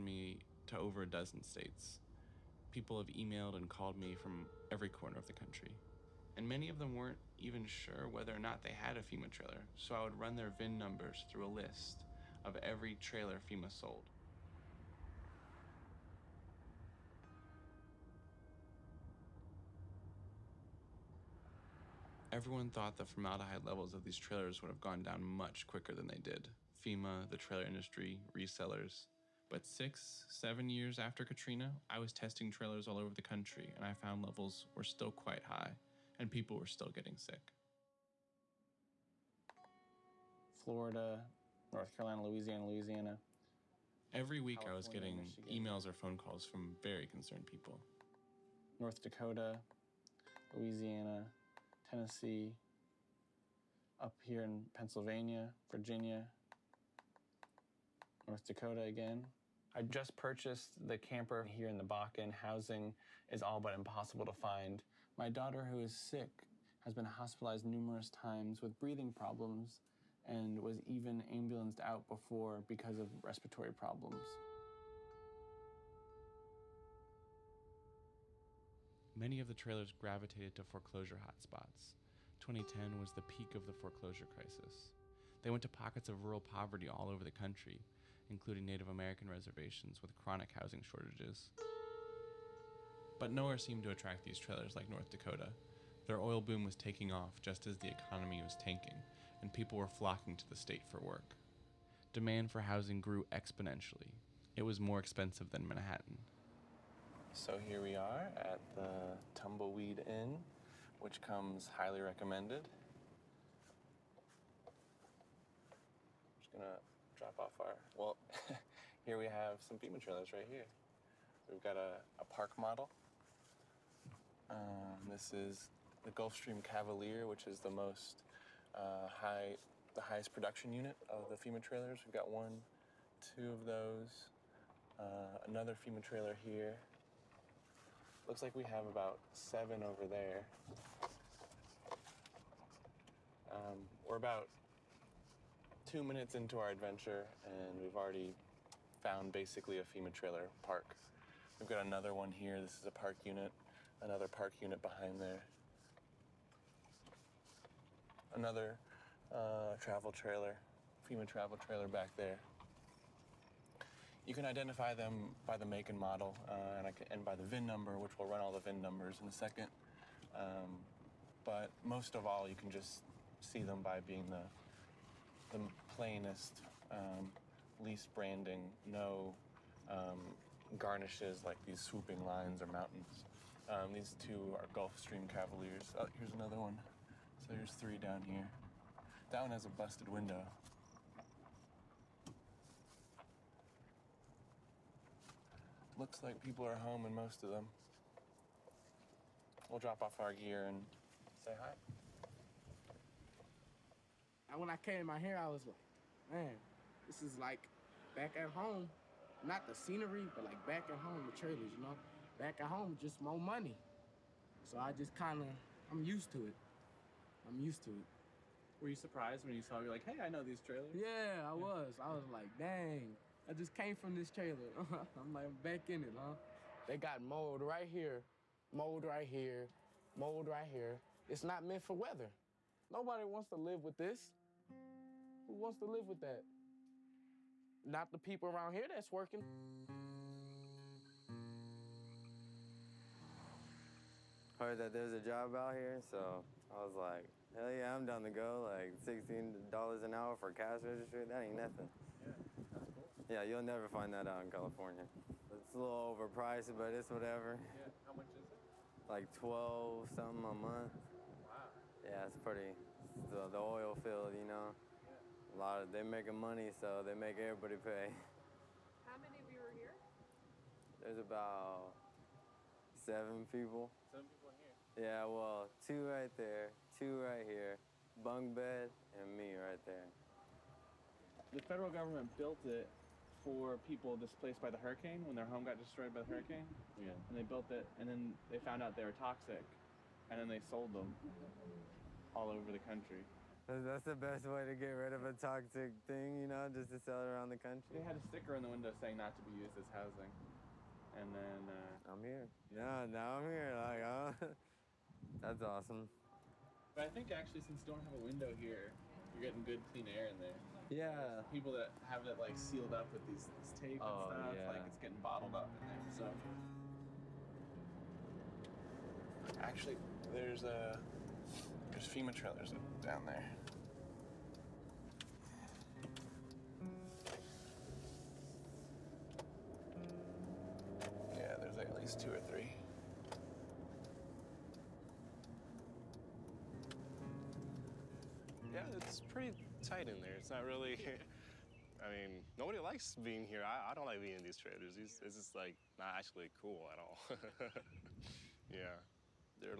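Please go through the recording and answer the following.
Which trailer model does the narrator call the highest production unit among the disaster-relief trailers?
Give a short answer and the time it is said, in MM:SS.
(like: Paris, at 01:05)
Gulfstream Cavalier, at 02:06.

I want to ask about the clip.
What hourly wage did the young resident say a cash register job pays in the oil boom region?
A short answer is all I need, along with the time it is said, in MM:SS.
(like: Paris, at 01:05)
$16 an hour, at 04:09.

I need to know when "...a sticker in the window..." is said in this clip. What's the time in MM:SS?
04:58.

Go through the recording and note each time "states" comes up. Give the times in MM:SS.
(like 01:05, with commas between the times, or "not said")
00:01, 01:40.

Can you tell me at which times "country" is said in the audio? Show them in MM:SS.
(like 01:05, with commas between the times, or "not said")
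00:05, 00:33, 01:27, 04:52, 04:57.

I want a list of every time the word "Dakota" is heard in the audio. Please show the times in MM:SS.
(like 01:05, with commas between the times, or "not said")
00:49, 00:58, 01:35.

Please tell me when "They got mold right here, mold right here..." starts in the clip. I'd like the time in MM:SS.
03:46.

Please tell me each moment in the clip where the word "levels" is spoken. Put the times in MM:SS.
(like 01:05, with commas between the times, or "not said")
00:23, 00:34.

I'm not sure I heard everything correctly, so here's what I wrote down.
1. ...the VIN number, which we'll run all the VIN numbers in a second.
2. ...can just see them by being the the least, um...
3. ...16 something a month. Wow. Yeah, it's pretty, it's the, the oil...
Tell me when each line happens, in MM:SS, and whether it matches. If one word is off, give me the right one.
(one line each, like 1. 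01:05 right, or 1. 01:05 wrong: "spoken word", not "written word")
1. 02:47 right
2. 02:52 wrong: "plainest", not "least"
3. 04:19 wrong: "12", not "16".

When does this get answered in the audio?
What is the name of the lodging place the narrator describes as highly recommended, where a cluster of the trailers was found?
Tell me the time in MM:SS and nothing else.
01:49.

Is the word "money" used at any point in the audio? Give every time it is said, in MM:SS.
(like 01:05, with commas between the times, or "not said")
03:33, 04:26.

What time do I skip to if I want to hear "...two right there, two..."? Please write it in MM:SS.
04:35.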